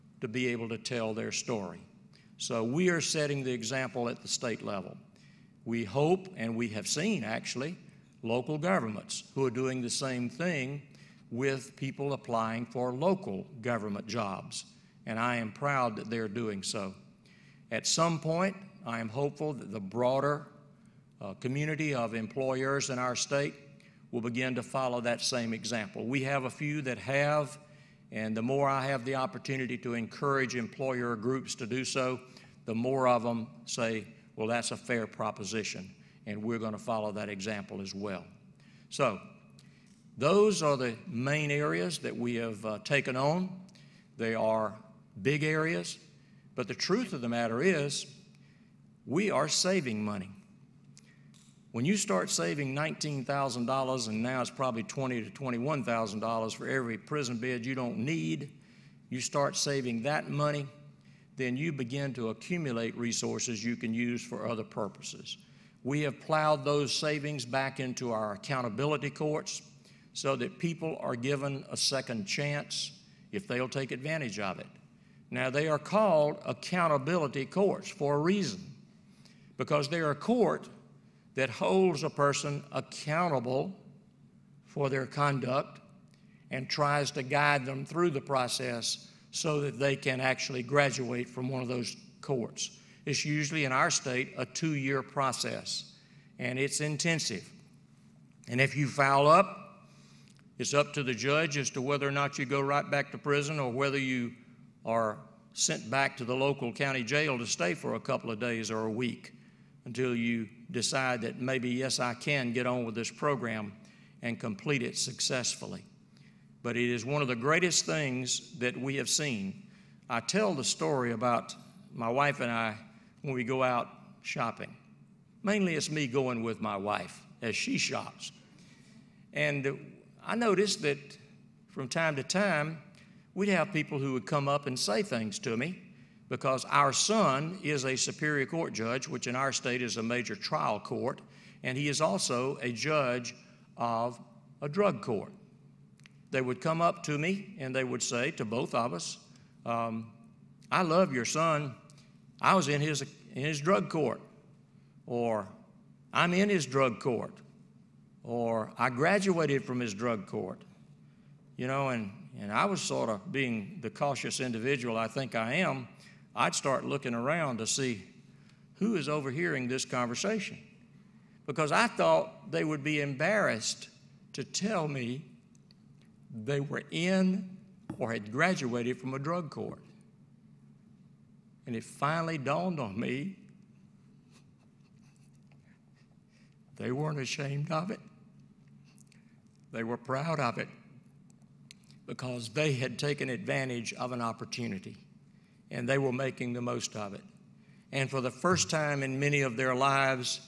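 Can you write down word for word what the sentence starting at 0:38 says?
So, those are the main areas that we have uh, taken on.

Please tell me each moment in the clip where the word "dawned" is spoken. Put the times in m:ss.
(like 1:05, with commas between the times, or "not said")
3:02.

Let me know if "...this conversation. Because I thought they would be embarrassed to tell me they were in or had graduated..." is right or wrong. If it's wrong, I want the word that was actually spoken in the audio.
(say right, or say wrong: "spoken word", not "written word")
right.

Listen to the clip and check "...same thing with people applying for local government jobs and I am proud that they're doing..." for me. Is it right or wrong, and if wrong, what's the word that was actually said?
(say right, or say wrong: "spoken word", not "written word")
right.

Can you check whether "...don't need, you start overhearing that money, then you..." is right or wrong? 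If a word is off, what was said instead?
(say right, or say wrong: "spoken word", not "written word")
wrong: "saving", not "overhearing".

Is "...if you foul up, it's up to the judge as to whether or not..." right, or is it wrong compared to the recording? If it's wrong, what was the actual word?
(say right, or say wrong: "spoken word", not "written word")
right.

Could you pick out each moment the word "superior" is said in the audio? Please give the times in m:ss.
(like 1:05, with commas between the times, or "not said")
2:17.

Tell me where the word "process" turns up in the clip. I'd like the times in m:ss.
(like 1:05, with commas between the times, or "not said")
1:28, 1:35.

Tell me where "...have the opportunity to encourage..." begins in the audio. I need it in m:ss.
0:28.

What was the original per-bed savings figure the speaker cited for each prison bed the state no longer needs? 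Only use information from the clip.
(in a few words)
$19,000.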